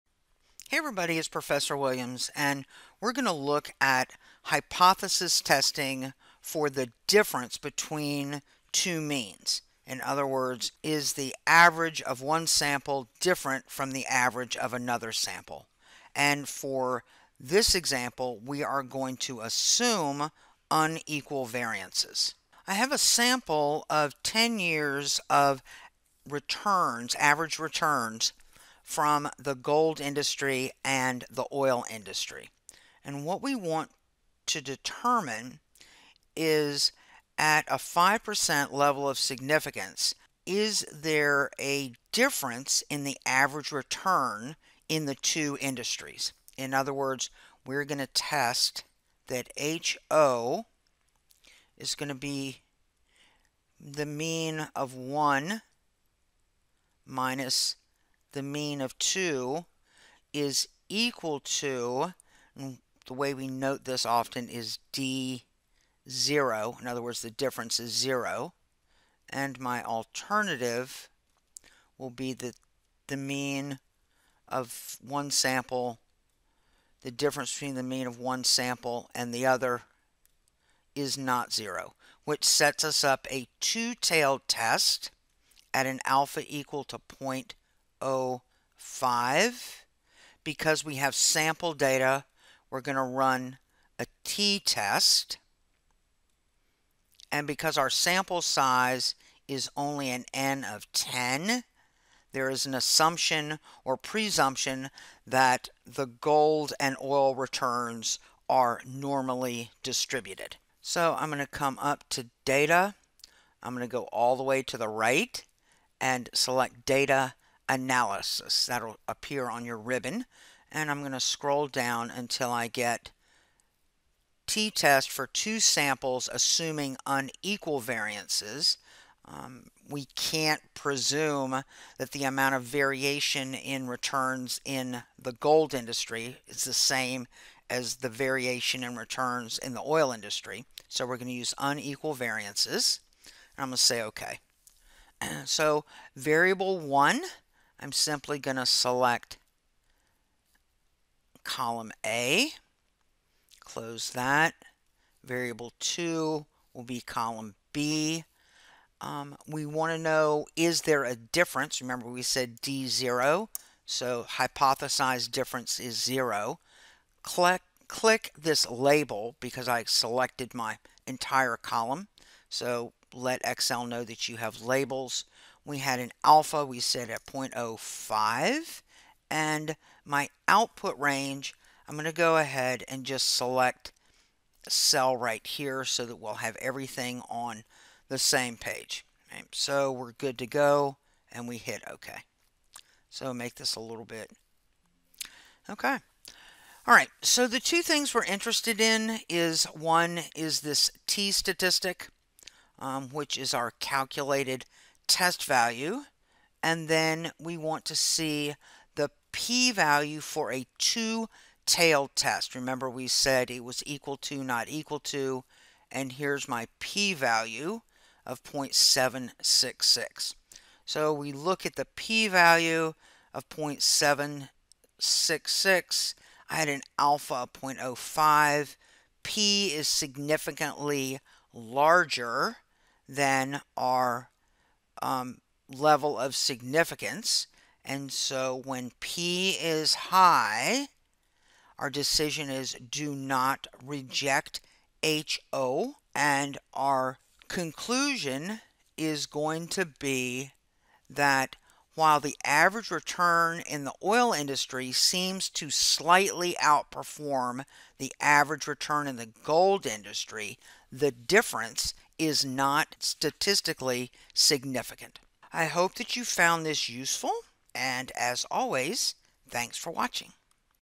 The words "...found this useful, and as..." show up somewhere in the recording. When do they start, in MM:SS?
04:26.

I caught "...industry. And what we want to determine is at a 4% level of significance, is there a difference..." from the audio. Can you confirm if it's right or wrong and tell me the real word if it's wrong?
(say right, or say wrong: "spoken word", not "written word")
wrong: "5", not "4".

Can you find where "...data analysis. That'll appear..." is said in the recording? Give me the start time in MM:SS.
01:56.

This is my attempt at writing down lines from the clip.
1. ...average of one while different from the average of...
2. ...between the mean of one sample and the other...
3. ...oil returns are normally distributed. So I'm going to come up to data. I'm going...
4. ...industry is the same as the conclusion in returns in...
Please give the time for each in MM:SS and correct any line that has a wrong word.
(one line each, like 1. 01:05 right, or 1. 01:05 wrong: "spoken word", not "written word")
1. 00:11 wrong: "sample", not "while"
2. 01:17 right
3. 01:47 right
4. 02:15 wrong: "variation", not "conclusion".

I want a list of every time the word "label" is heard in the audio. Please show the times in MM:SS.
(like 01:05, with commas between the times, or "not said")
02:48, 02:54.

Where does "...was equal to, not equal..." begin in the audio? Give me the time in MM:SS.
03:33.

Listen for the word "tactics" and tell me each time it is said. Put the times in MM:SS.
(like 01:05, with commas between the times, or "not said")
not said.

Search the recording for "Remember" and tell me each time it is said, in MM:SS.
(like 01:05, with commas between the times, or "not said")
02:41, 03:32.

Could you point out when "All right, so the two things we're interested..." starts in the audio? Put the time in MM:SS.
03:16.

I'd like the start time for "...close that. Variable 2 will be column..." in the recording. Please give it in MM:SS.
02:33.